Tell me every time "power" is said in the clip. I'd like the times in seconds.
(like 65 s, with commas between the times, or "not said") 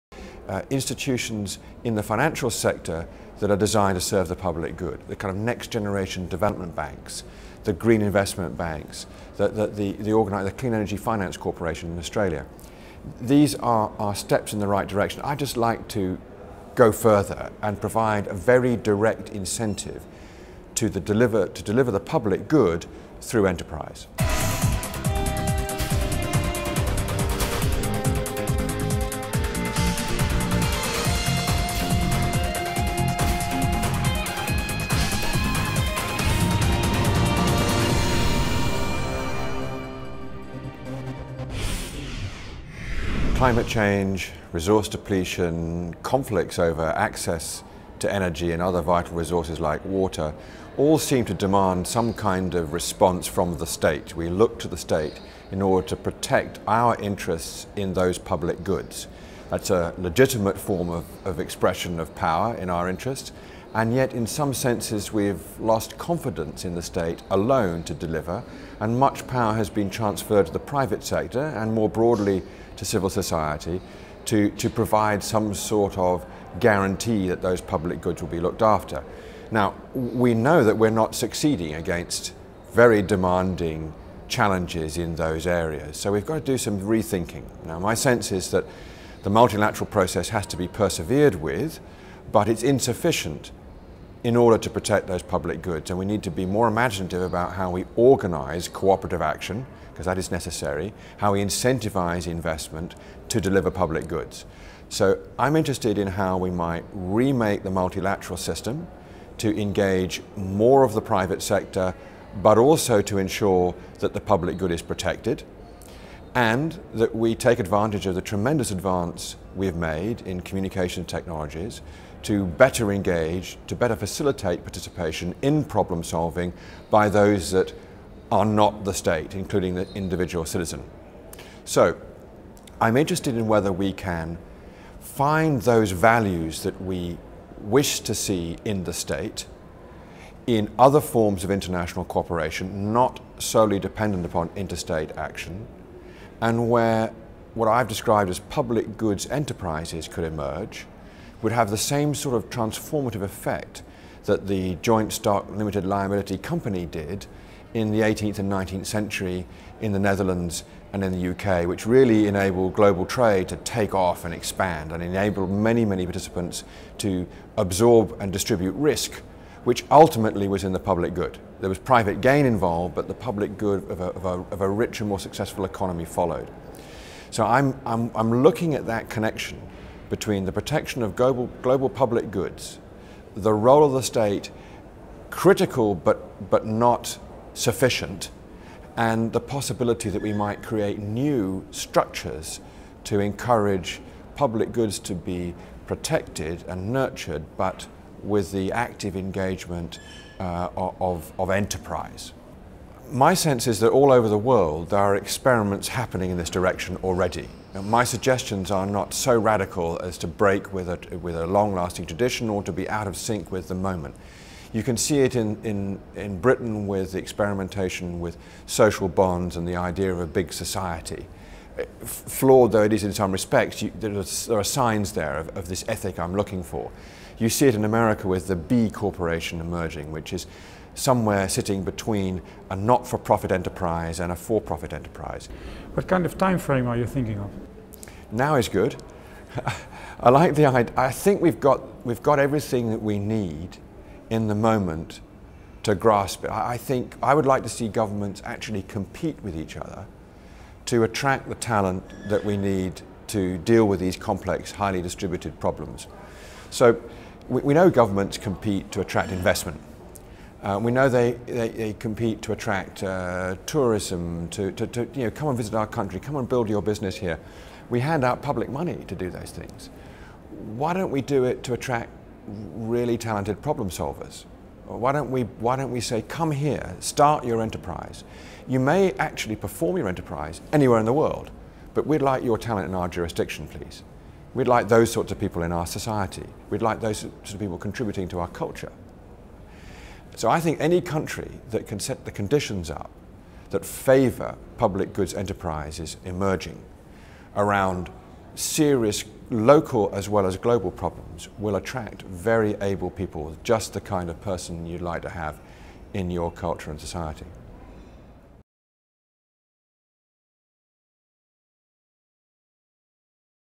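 62 s, 69 s.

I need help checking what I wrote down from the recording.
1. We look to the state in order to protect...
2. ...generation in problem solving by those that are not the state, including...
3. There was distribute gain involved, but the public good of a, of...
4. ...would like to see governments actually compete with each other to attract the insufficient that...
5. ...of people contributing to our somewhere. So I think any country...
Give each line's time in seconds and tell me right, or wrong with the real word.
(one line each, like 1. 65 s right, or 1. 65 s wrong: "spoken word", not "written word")
1. 54 s right
2. 124 s wrong: "participation", not "generation"
3. 171 s wrong: "private", not "distribute"
4. 247 s wrong: "talent", not "insufficient"
5. 287 s wrong: "culture", not "somewhere".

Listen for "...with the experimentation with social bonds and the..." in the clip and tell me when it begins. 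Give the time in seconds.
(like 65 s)
216 s.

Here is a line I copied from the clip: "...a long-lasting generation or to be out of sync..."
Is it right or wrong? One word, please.
wrong.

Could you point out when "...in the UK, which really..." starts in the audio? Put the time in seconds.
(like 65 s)
161 s.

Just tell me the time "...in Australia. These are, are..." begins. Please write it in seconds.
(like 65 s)
11 s.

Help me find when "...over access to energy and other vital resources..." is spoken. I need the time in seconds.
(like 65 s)
46 s.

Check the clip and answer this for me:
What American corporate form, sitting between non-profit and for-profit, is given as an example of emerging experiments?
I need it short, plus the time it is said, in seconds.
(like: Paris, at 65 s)
B Corporation, at 228 s.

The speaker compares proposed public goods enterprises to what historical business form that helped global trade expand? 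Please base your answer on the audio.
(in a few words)
joint stock limited liability company.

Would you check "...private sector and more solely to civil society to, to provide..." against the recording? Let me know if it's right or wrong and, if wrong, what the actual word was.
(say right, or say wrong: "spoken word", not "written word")
wrong: "broadly", not "solely".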